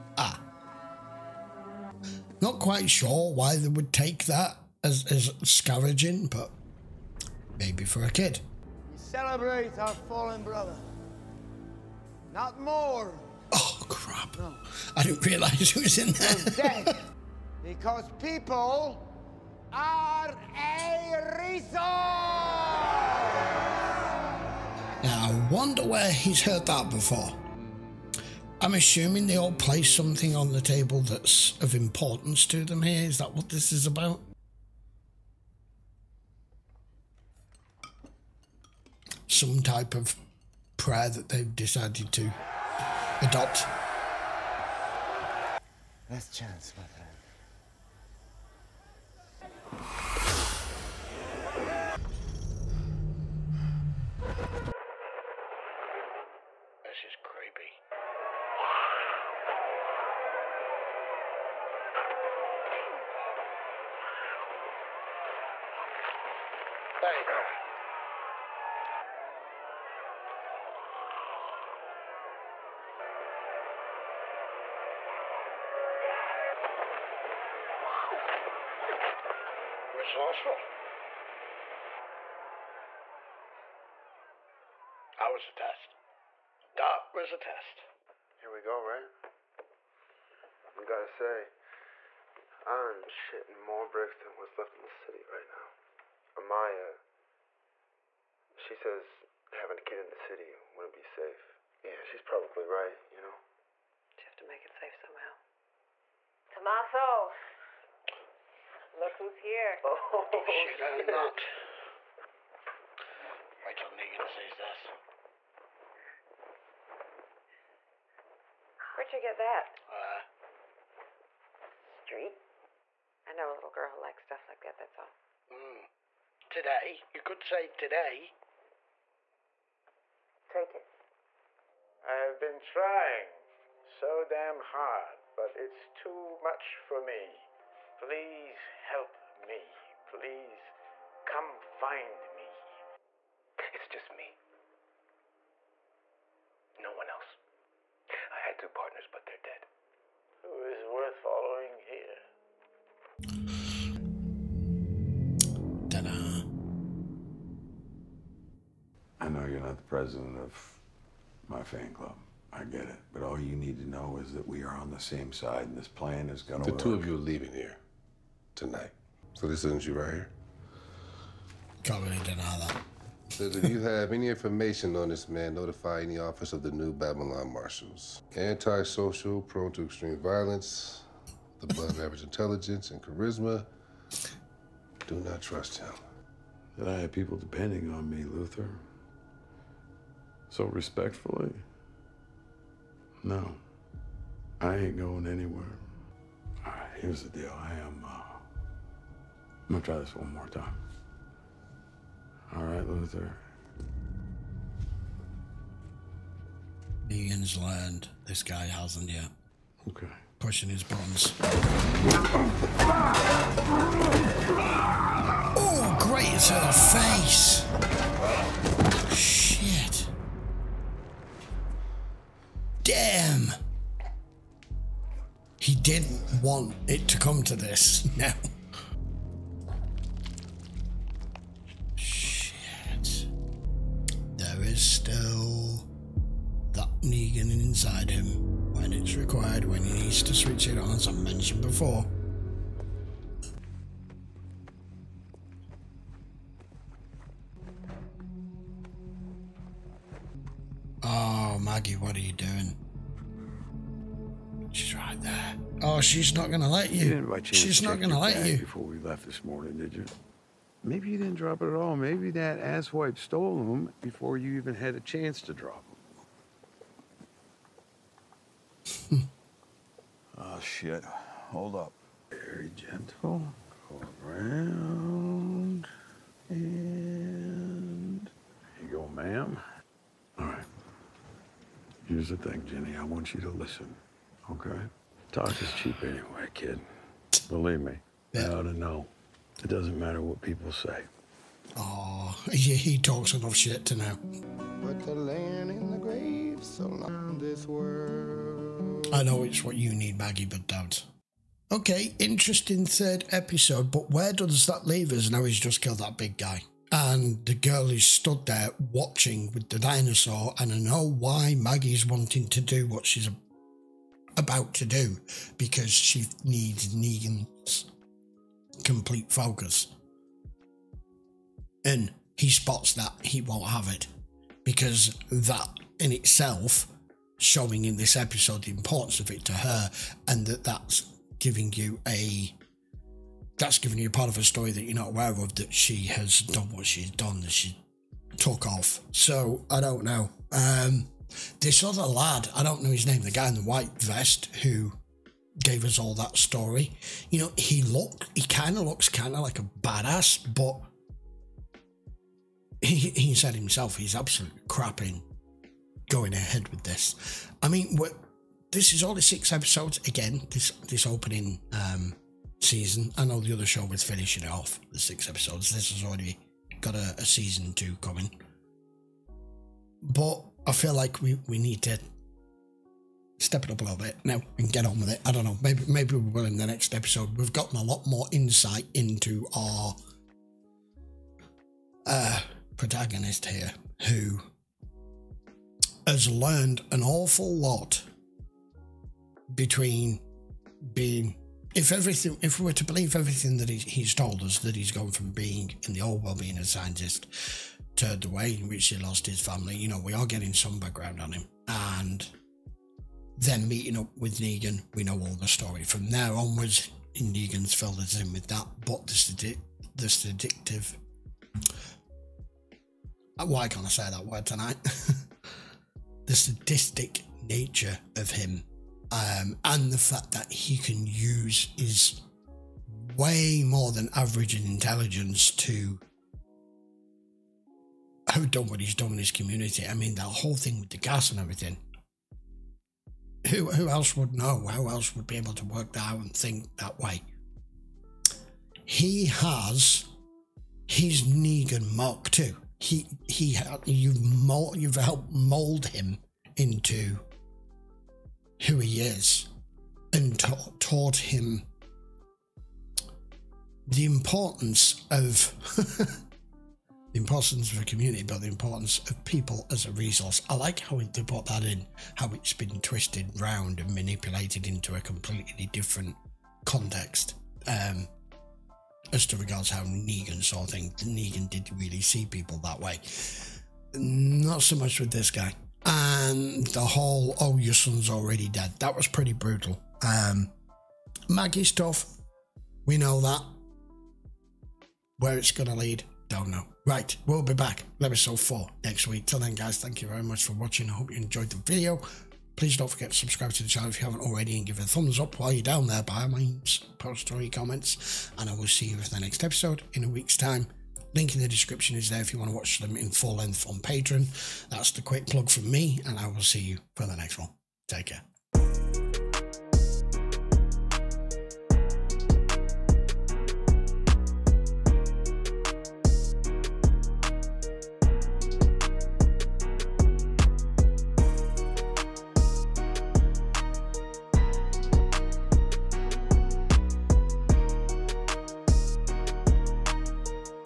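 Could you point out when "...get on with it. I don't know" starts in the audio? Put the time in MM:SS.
06:14.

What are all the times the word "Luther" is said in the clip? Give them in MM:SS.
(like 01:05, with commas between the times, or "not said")
03:08, 03:22.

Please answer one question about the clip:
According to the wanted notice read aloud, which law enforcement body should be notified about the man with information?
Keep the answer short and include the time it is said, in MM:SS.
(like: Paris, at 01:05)
New Babylon Marshals, at 02:56.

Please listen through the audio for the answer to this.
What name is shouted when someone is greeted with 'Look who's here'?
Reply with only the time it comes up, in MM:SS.
01:46.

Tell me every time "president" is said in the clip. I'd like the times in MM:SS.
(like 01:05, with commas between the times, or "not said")
02:39.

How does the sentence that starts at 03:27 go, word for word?
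Negan's learned this guy hasn't yet.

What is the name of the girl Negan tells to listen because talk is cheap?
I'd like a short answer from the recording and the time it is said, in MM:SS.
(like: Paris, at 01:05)
Ginny, at 04:42.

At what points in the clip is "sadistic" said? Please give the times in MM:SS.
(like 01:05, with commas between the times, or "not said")
06:56.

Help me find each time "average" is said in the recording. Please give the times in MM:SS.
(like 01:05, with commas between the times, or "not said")
03:02, 07:04.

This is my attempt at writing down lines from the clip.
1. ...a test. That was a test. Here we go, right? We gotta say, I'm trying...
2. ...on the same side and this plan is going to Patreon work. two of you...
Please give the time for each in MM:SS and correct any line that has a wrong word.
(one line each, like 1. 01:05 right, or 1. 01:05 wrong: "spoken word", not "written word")
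1. 01:25 wrong: "shitting", not "trying"
2. 02:44 wrong: "The", not "Patreon".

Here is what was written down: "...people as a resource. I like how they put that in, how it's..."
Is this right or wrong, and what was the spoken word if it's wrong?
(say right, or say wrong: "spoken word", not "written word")
right.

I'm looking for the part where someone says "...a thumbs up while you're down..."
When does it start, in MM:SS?
08:14.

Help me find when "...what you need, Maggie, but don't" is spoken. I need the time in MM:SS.
04:59.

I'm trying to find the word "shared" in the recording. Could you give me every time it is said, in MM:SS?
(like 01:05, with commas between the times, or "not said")
not said.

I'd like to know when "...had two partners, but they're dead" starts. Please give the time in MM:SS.
02:28.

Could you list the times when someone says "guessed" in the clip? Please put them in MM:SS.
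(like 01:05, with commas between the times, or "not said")
not said.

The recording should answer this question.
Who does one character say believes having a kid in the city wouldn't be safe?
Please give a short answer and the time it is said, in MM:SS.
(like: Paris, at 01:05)
Amaia, at 01:36.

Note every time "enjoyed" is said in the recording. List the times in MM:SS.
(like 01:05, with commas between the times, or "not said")
08:11.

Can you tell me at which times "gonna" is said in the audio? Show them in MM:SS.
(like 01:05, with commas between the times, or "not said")
03:19.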